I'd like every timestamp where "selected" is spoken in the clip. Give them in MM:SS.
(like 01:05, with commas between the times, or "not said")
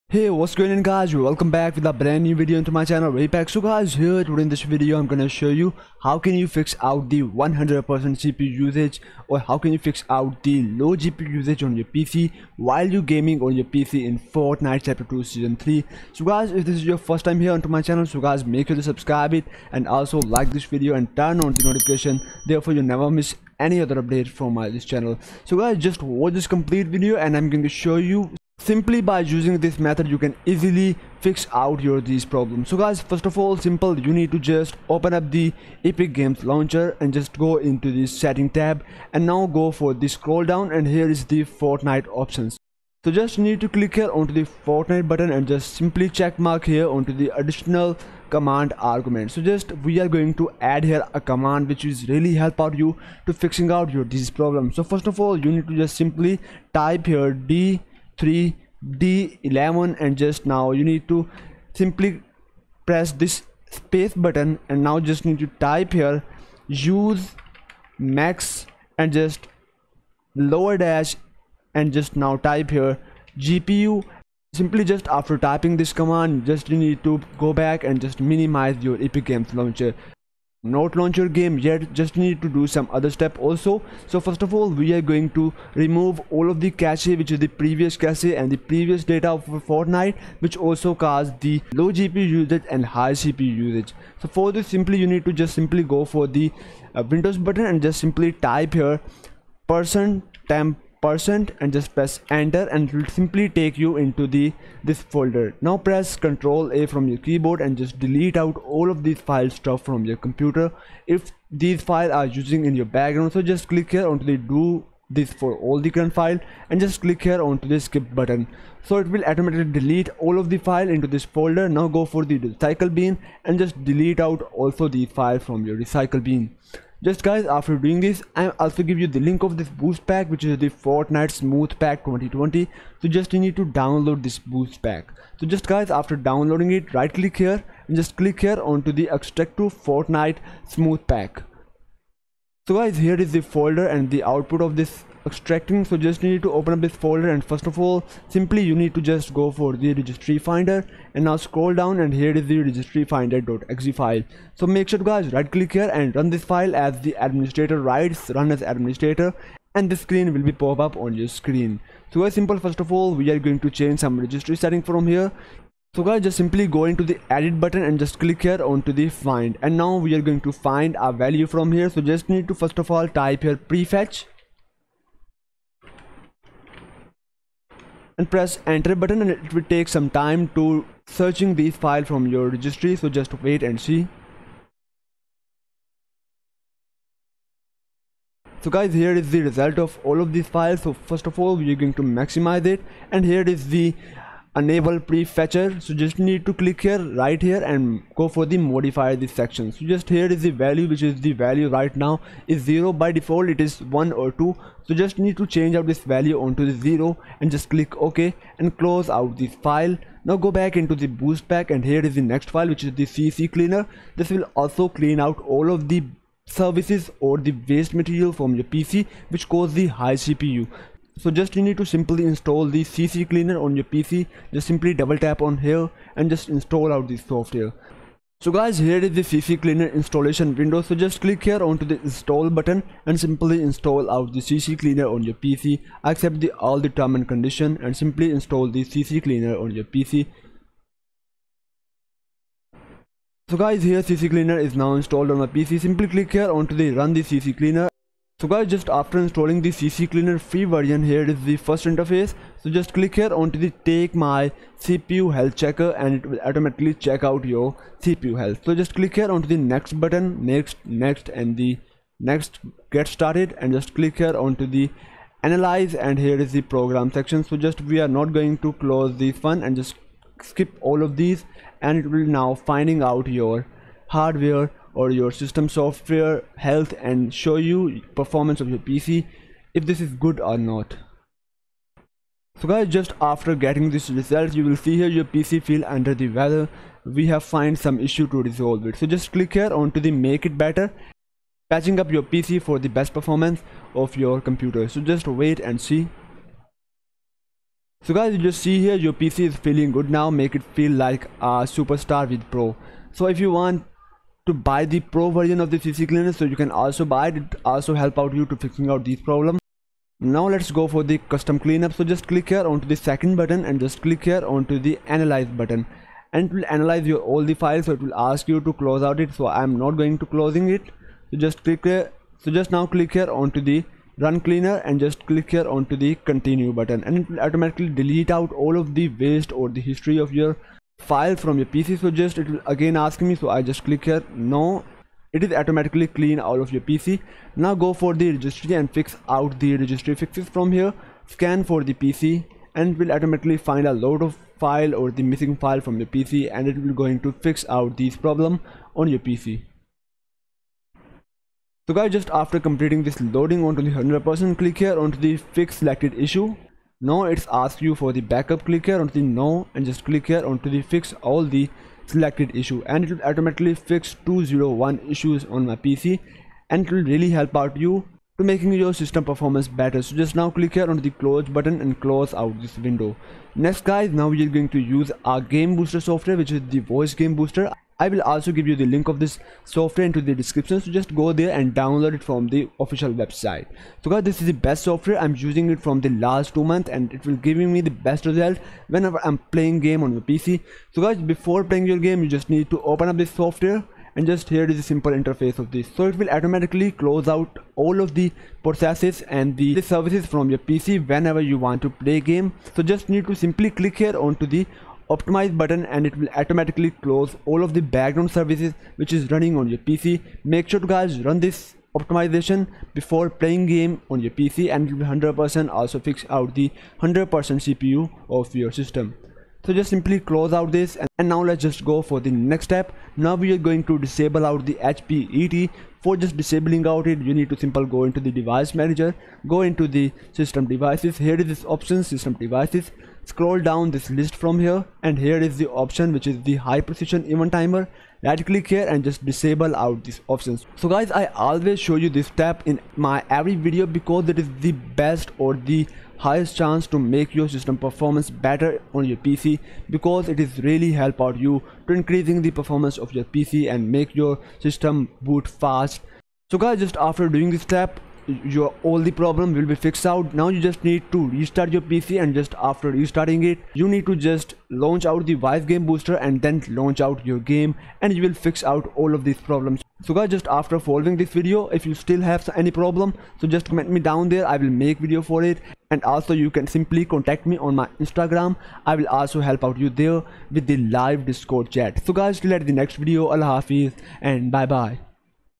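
05:55, 06:02.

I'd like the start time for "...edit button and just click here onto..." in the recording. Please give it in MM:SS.
02:47.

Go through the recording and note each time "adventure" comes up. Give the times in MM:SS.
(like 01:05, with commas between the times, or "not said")
not said.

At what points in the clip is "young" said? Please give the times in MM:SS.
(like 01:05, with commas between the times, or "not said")
not said.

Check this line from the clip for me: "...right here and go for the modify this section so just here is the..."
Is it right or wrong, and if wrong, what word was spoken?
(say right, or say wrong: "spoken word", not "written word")
right.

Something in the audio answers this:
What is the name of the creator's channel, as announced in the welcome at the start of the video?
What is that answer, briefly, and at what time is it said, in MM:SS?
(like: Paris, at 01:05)
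RiPEX, at 00:03.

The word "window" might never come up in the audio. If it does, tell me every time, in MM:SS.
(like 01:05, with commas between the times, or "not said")
01:37, 03:50, 06:12.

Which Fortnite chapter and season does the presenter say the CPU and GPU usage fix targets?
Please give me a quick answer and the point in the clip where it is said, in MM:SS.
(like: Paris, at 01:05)
Chapter 2 Season 3, at 00:14.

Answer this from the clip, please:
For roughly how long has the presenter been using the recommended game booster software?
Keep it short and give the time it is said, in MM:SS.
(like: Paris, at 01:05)
two months, at 06:26.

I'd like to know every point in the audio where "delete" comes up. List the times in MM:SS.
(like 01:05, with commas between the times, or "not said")
01:48, 01:59, 02:03, 05:27.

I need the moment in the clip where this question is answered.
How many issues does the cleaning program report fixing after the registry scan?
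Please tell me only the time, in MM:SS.
06:04.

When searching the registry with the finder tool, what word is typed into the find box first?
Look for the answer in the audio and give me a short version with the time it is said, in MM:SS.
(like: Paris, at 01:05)
prefetch, at 02:53.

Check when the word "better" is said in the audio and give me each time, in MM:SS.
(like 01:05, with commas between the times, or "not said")
04:50, 06:09, 07:28.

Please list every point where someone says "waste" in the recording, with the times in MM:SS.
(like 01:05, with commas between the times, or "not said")
03:37, 05:29.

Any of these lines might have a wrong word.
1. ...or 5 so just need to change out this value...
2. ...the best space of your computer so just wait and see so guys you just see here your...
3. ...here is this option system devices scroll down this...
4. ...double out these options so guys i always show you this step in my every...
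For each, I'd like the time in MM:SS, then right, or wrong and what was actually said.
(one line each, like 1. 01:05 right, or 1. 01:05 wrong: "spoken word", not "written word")
1. 03:24 wrong: "2", not "5"
2. 04:52 wrong: "performance", not "space"
3. 07:11 right
4. 07:19 wrong: "disable", not "double".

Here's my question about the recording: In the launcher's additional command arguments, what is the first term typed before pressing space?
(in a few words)
D3D11.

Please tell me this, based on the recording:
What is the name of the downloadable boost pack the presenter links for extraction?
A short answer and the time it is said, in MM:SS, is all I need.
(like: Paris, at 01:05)
Fortnite Smooth Pack 2020, at 02:10.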